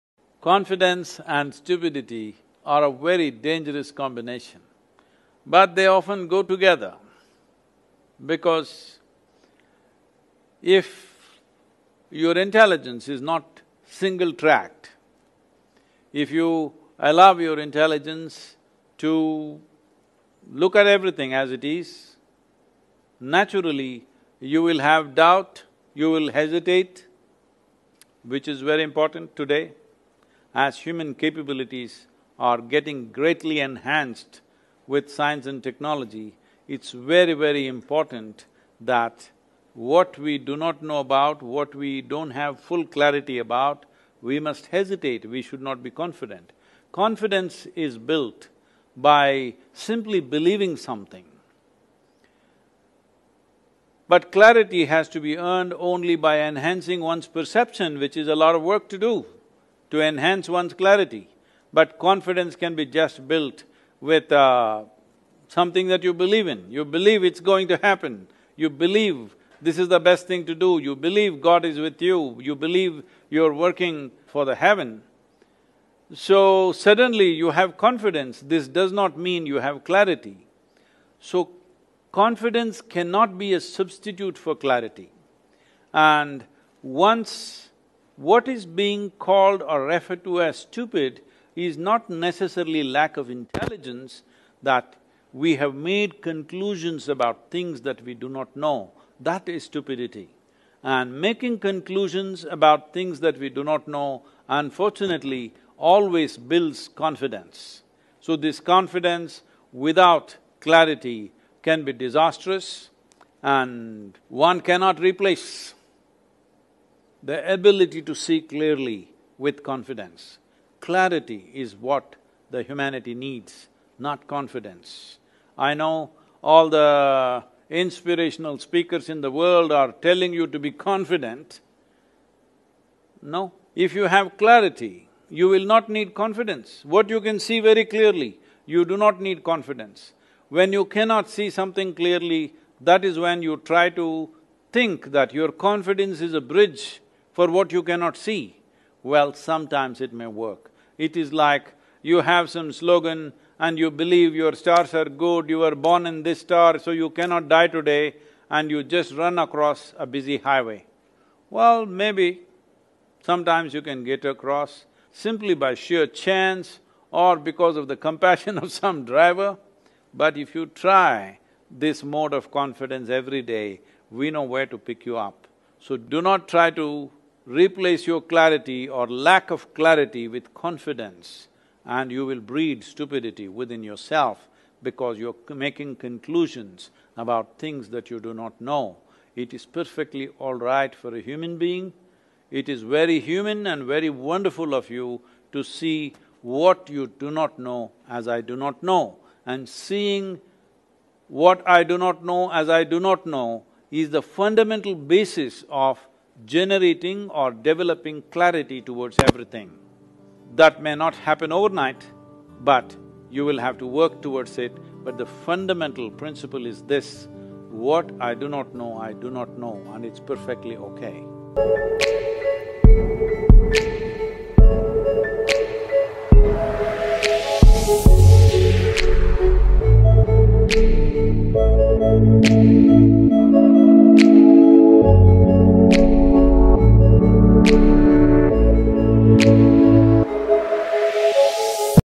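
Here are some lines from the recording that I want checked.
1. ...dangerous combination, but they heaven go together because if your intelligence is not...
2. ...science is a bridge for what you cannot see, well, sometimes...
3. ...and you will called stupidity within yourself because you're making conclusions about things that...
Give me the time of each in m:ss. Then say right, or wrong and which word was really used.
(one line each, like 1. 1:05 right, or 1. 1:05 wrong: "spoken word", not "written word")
1. 0:03 wrong: "often", not "heaven"
2. 2:25 wrong: "confidence", not "science"
3. 3:01 wrong: "breed", not "called".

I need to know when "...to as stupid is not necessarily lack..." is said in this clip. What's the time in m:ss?
1:30.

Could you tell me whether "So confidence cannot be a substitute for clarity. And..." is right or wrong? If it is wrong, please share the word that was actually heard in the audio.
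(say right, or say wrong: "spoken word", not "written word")
right.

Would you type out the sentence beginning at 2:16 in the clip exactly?
What you can see very clearly, you do not need confidence.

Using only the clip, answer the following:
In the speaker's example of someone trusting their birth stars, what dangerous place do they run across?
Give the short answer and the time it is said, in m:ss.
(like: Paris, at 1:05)
A busy highway, at 2:40.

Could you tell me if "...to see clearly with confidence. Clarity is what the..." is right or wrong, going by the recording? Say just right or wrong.
right.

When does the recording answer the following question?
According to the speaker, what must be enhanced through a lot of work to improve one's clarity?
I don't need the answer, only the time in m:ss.
0:56.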